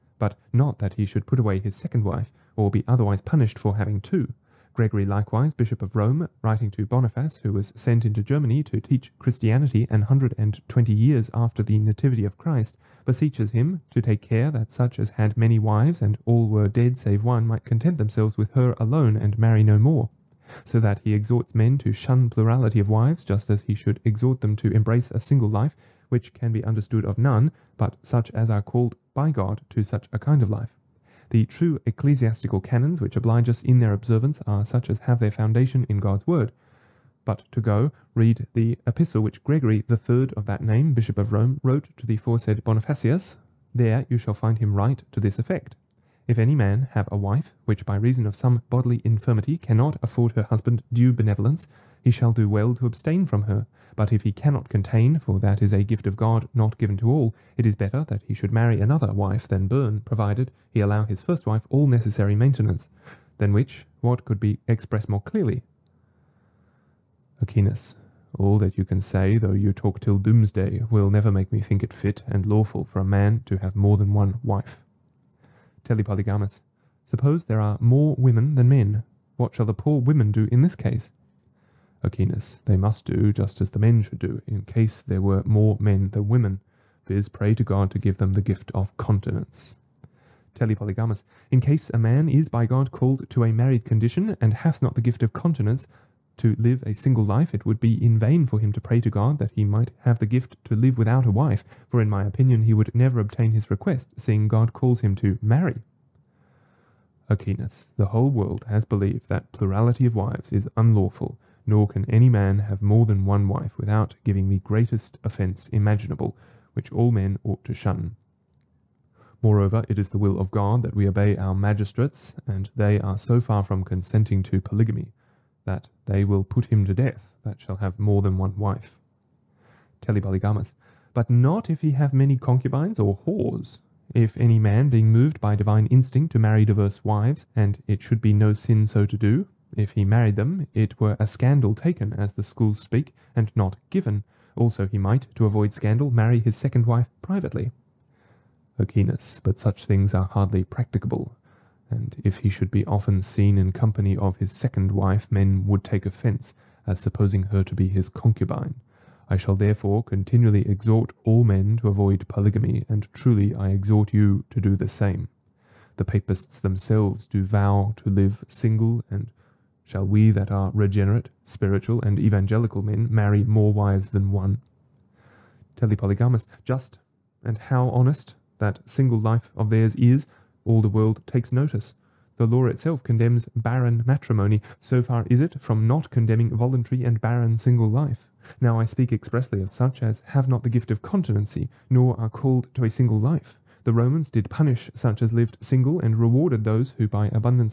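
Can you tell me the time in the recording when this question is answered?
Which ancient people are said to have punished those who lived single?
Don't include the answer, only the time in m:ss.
3:13.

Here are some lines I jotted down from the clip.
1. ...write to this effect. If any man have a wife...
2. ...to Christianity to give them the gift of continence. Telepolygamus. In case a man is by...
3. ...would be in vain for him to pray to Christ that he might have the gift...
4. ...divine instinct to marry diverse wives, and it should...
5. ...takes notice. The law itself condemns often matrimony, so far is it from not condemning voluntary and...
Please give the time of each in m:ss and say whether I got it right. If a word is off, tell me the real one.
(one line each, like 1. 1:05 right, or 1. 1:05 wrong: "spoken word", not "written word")
1. 0:44 right
2. 1:27 wrong: "God", not "Christianity"
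3. 1:37 wrong: "God", not "Christ"
4. 2:15 right
5. 3:01 wrong: "barren", not "often".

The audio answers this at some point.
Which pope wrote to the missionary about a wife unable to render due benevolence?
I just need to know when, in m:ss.
0:39.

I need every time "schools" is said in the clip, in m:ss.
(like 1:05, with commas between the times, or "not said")
2:22.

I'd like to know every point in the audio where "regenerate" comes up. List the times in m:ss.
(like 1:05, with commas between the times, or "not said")
2:50.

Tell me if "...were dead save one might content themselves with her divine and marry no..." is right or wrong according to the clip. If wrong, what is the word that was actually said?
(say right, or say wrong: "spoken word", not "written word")
wrong: "alone", not "divine".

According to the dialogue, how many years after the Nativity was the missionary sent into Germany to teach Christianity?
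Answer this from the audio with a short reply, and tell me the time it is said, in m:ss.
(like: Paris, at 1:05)
120, at 0:09.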